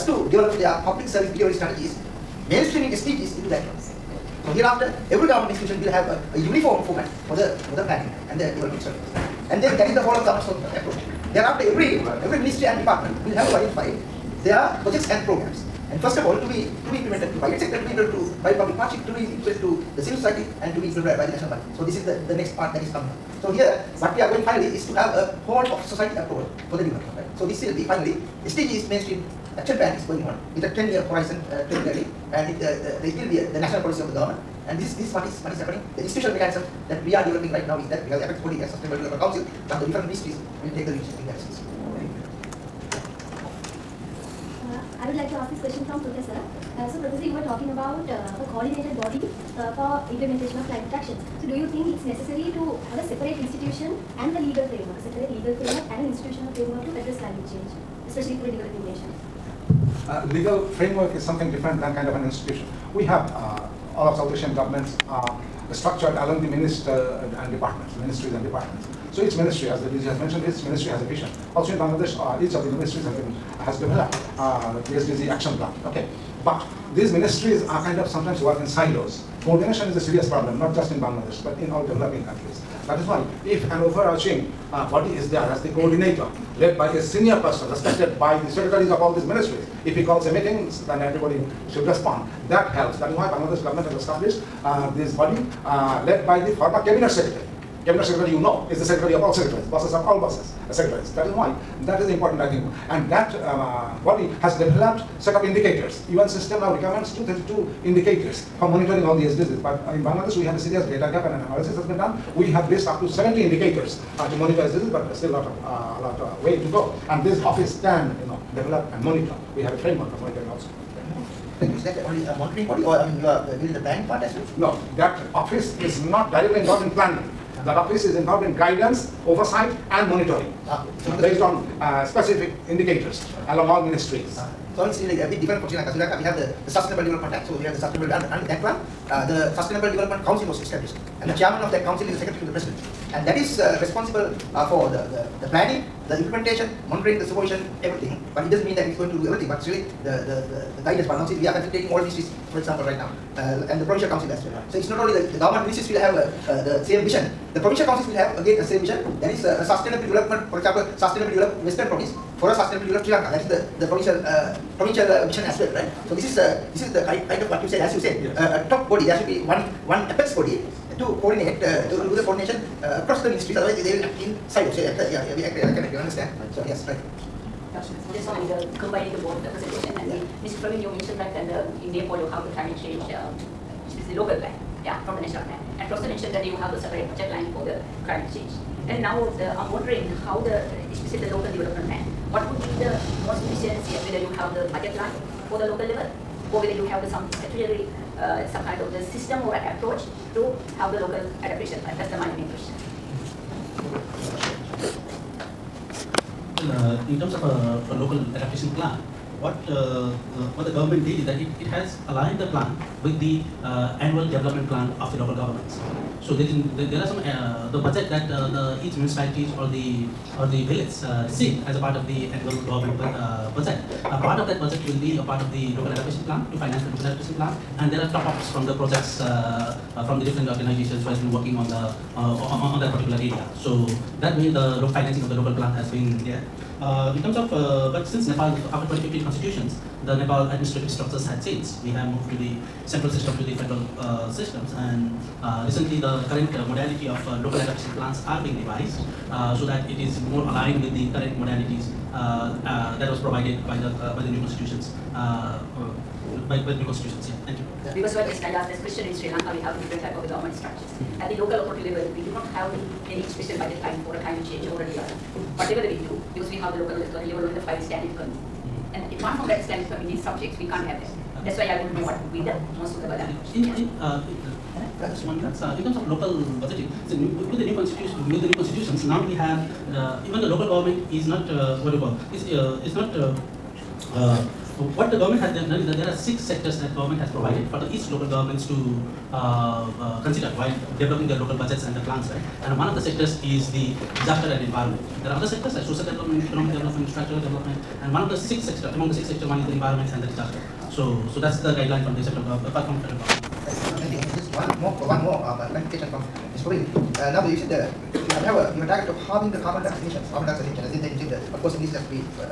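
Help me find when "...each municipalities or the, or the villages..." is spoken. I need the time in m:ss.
3:38.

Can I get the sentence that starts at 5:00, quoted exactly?
So, so that's the guideline from the central government, from federal government.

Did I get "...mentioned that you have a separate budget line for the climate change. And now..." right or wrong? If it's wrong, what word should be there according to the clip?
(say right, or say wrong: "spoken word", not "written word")
right.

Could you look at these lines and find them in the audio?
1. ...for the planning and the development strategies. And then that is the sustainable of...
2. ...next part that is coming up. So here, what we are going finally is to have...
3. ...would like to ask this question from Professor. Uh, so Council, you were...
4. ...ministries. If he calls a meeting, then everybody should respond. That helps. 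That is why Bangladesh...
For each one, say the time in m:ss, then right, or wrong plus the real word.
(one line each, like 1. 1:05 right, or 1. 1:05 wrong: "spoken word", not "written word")
1. 0:07 wrong: "whole", not "sustainable"
2. 0:22 right
3. 0:45 wrong: "Professor", not "Council"
4. 1:29 right.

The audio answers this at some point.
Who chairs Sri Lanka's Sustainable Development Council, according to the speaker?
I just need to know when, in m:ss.
2:22.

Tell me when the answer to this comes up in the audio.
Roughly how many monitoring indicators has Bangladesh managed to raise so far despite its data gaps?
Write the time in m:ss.
1:53.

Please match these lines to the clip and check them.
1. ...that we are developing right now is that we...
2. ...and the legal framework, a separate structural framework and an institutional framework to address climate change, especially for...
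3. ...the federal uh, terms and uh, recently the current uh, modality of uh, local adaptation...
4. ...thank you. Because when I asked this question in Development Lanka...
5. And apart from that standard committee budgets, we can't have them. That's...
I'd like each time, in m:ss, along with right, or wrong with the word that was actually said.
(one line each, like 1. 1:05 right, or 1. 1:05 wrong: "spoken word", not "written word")
1. 0:36 right
2. 0:54 wrong: "legal", not "structural"
3. 4:03 wrong: "systems", not "terms"
4. 4:17 wrong: "Sri", not "Development"
5. 4:28 wrong: "subjects", not "budgets".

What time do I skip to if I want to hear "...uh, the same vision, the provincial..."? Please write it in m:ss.
2:36.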